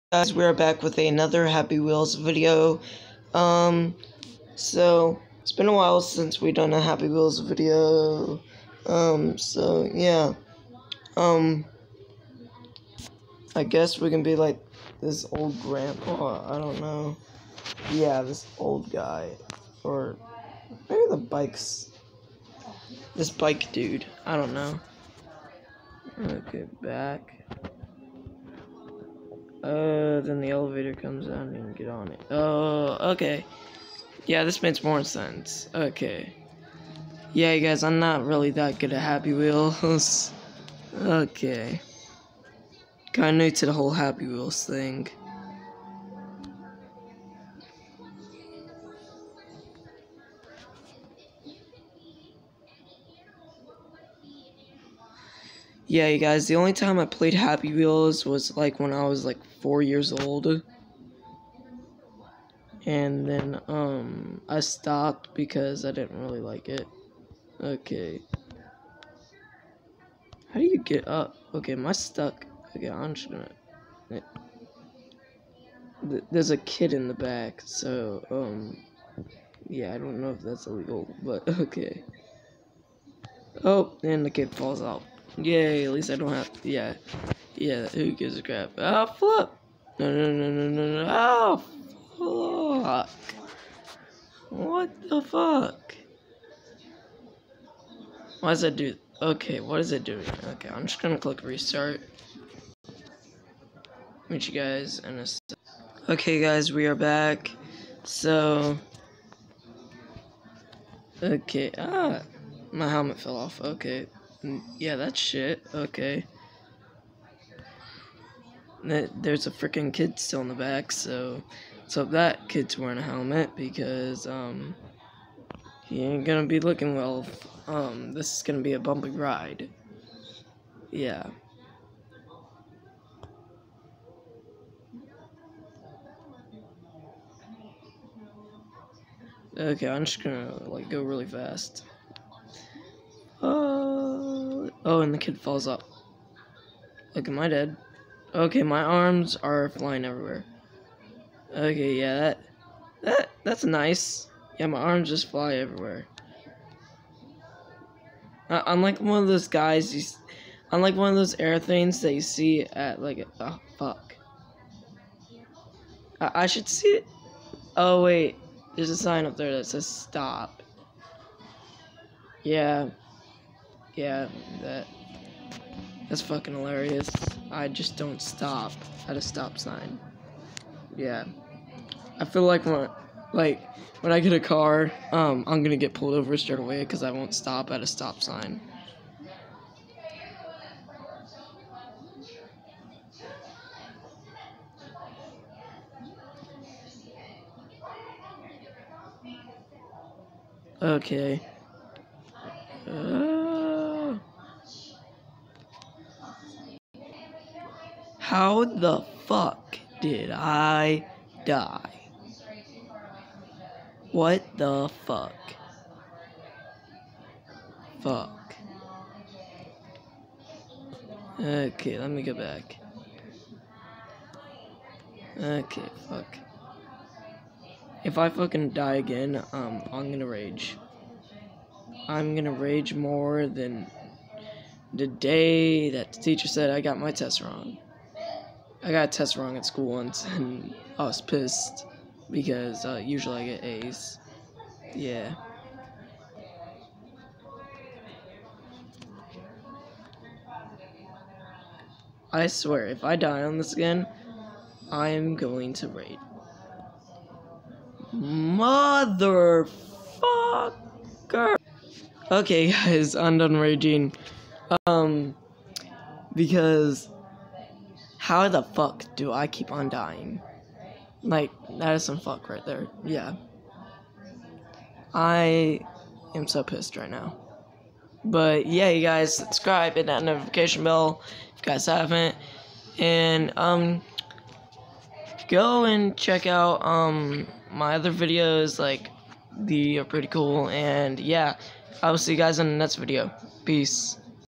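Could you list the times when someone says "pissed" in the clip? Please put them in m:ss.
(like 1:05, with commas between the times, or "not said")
4:01, 4:36.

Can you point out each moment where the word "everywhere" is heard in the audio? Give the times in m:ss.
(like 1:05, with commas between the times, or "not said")
2:30, 2:35.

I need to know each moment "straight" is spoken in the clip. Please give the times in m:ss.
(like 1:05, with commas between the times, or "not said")
3:06.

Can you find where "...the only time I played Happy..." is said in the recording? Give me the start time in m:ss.
0:56.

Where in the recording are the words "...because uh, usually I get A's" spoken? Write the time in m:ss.
4:02.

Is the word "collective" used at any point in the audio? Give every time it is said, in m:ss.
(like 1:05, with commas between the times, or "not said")
not said.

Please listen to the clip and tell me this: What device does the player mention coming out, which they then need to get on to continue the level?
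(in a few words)
elevator.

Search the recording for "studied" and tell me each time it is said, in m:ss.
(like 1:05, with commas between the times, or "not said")
not said.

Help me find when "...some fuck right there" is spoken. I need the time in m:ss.
4:32.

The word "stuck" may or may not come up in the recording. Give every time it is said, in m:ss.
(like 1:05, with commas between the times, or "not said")
1:11.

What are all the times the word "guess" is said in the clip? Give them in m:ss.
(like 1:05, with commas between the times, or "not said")
0:13.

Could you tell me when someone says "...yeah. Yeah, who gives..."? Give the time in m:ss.
1:26.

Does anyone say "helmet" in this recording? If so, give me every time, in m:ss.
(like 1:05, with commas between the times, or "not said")
1:52, 2:03.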